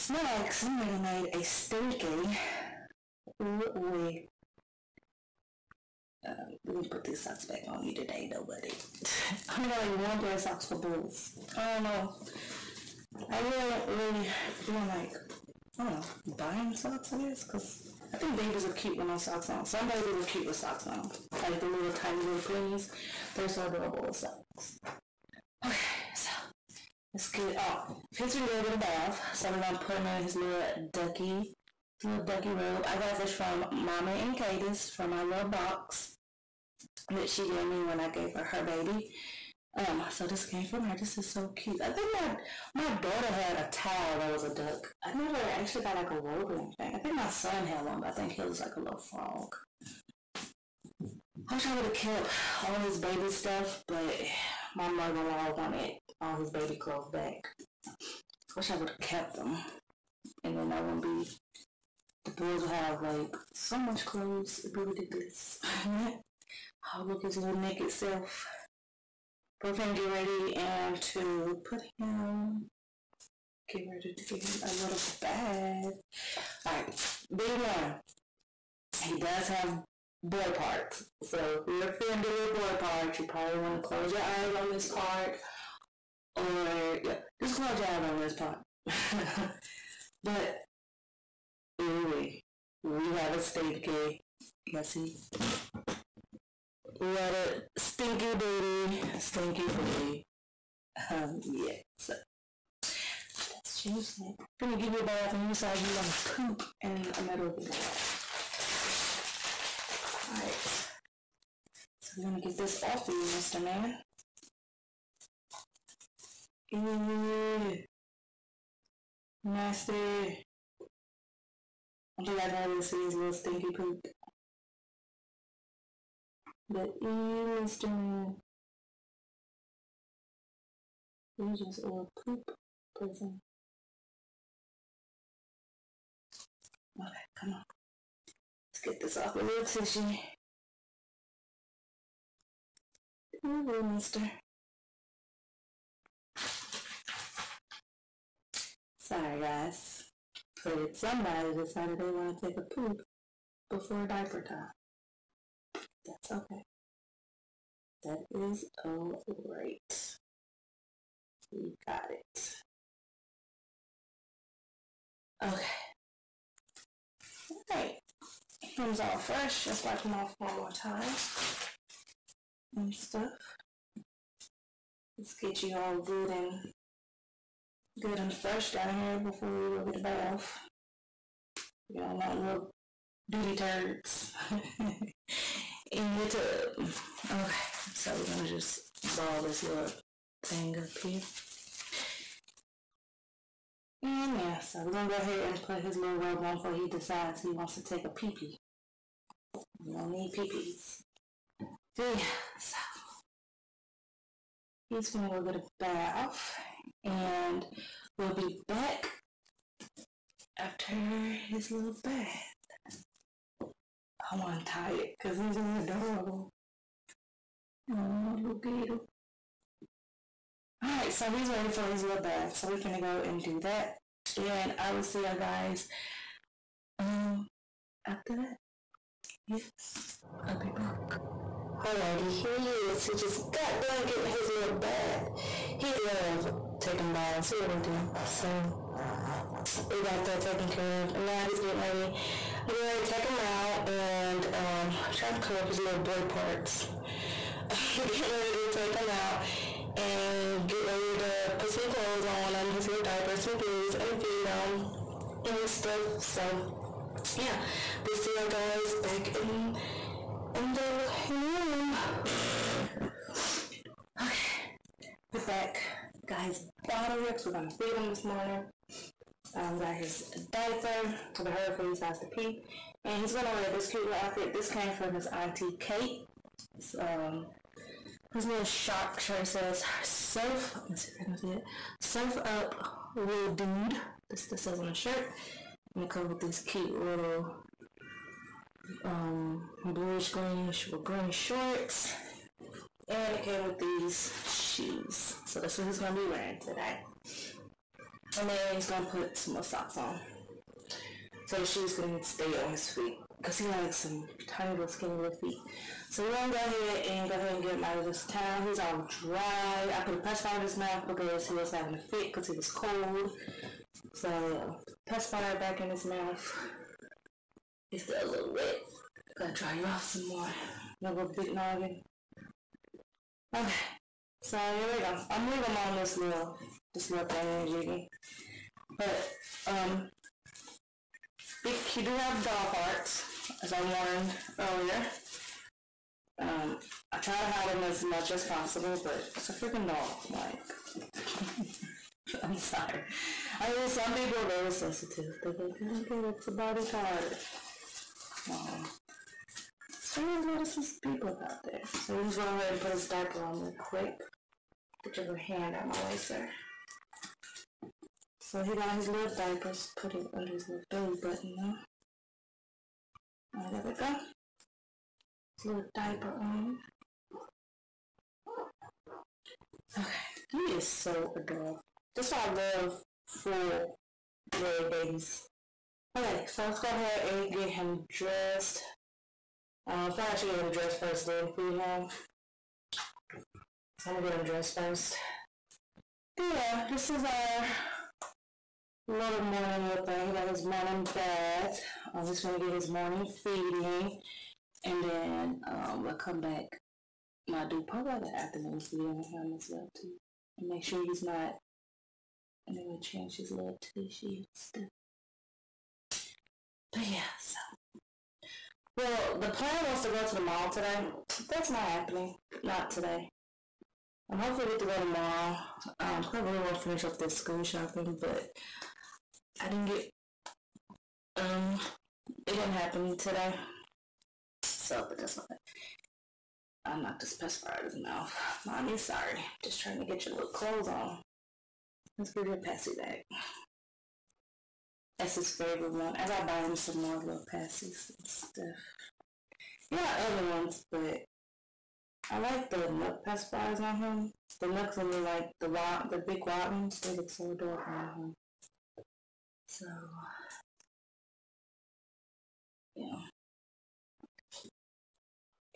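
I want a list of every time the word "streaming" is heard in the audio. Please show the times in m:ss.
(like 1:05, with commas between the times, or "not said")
not said.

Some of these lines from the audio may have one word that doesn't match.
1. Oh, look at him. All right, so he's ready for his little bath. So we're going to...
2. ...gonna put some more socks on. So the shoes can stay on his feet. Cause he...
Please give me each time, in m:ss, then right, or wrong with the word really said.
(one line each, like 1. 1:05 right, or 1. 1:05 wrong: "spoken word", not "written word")
1. 3:37 right
2. 4:58 right.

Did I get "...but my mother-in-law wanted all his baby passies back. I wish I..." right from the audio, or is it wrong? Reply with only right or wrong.
wrong.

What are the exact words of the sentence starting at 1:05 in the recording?
I'll look his little naked self.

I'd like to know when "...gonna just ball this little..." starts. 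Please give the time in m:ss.
3:08.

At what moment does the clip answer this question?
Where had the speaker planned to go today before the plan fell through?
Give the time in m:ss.
6:50.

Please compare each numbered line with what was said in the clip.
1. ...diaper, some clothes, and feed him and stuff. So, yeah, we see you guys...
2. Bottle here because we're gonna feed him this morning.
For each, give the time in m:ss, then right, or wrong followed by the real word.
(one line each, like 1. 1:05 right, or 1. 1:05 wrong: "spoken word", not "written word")
1. 4:13 right
2. 4:26 right.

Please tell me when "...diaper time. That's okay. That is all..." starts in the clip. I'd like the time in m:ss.
2:34.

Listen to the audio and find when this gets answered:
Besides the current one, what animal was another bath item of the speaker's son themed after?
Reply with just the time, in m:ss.
0:49.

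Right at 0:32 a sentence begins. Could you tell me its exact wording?
I got this from Mama and Cadis from my little box that she gave me when I gave her her baby.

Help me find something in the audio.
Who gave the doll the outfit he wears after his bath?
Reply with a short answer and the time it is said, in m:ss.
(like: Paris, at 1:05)
Auntie Kate, at 4:35.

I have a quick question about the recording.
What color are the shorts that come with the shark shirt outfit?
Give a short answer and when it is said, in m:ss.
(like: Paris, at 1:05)
Bluish green, at 4:49.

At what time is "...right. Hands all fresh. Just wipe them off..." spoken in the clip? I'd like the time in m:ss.
2:47.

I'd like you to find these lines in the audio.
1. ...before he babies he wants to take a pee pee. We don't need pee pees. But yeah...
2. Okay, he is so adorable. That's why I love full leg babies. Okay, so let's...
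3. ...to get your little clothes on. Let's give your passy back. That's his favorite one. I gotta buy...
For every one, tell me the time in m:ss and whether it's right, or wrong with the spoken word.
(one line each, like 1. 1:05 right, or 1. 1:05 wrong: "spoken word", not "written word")
1. 3:16 wrong: "decides", not "babies"
2. 6:09 right
3. 7:09 right.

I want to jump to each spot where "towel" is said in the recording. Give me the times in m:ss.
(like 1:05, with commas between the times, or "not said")
0:43, 5:08.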